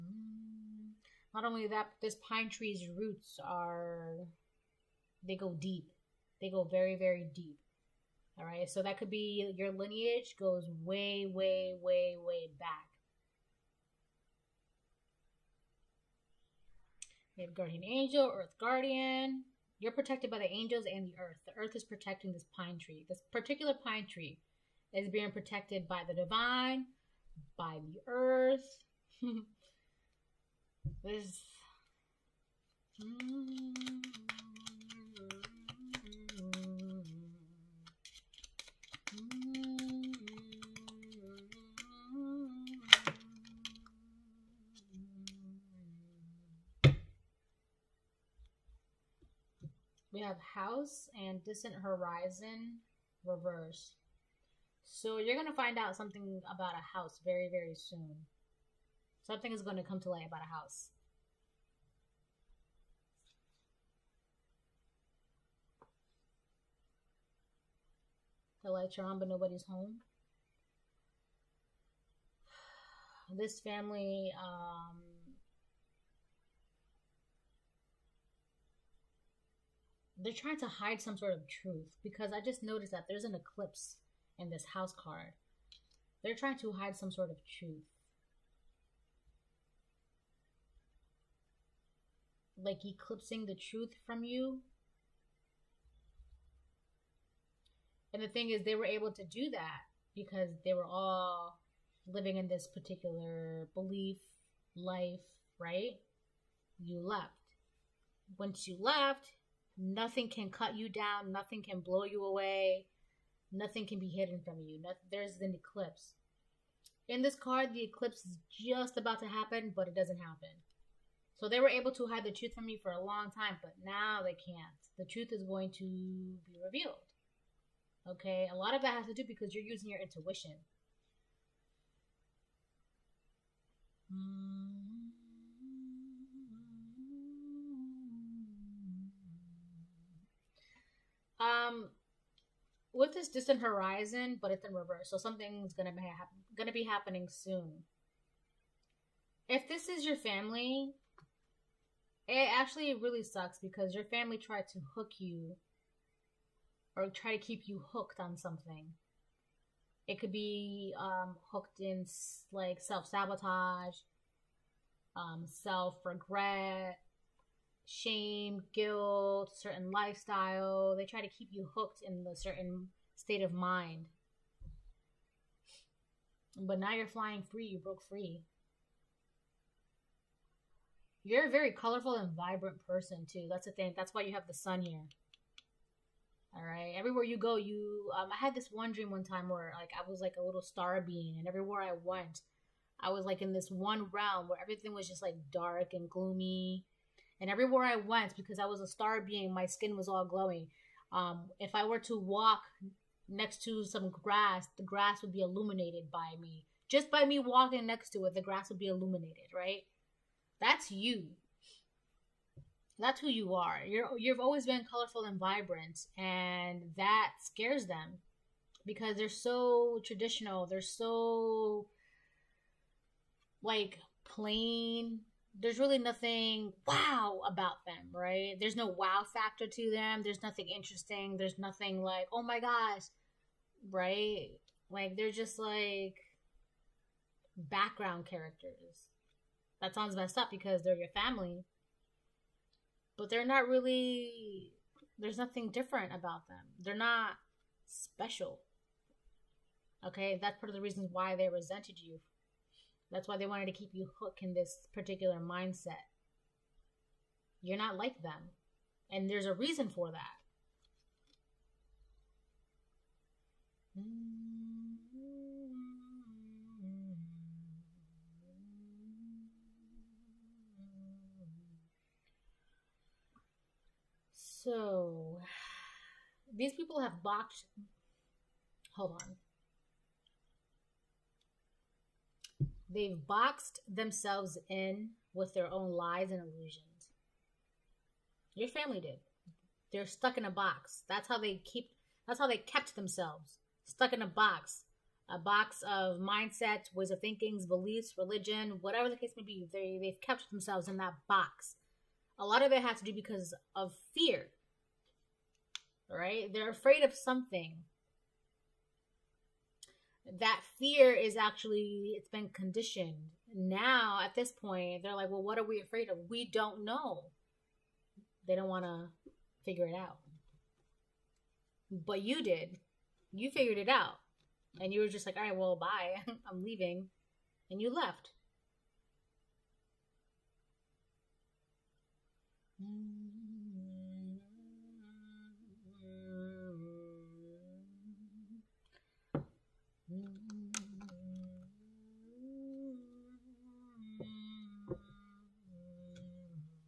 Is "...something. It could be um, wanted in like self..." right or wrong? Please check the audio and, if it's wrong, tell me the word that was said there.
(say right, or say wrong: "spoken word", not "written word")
wrong: "hooked", not "wanted".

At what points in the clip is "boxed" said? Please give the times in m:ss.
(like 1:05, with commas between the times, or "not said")
4:37, 4:43.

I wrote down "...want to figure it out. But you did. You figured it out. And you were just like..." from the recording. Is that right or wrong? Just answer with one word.
right.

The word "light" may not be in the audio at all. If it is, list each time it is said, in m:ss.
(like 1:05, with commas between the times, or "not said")
1:00, 1:08.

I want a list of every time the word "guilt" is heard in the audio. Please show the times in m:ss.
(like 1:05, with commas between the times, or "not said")
2:48.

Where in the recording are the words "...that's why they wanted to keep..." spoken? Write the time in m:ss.
4:13.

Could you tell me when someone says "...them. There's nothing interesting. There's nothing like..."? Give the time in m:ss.
3:49.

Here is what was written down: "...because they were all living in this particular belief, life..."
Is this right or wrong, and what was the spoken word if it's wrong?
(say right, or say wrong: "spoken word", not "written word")
right.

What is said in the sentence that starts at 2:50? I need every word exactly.
They try to keep you hooked in a certain state of mind.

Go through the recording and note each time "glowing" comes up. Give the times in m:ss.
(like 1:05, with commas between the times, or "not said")
3:20.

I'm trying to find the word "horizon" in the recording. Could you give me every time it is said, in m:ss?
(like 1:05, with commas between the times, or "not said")
0:51, 2:23.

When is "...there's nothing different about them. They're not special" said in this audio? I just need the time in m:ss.
4:05.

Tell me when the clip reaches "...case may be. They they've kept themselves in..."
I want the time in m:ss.
4:59.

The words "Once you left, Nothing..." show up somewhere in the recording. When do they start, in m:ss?
1:48.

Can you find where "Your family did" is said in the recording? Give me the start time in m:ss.
4:48.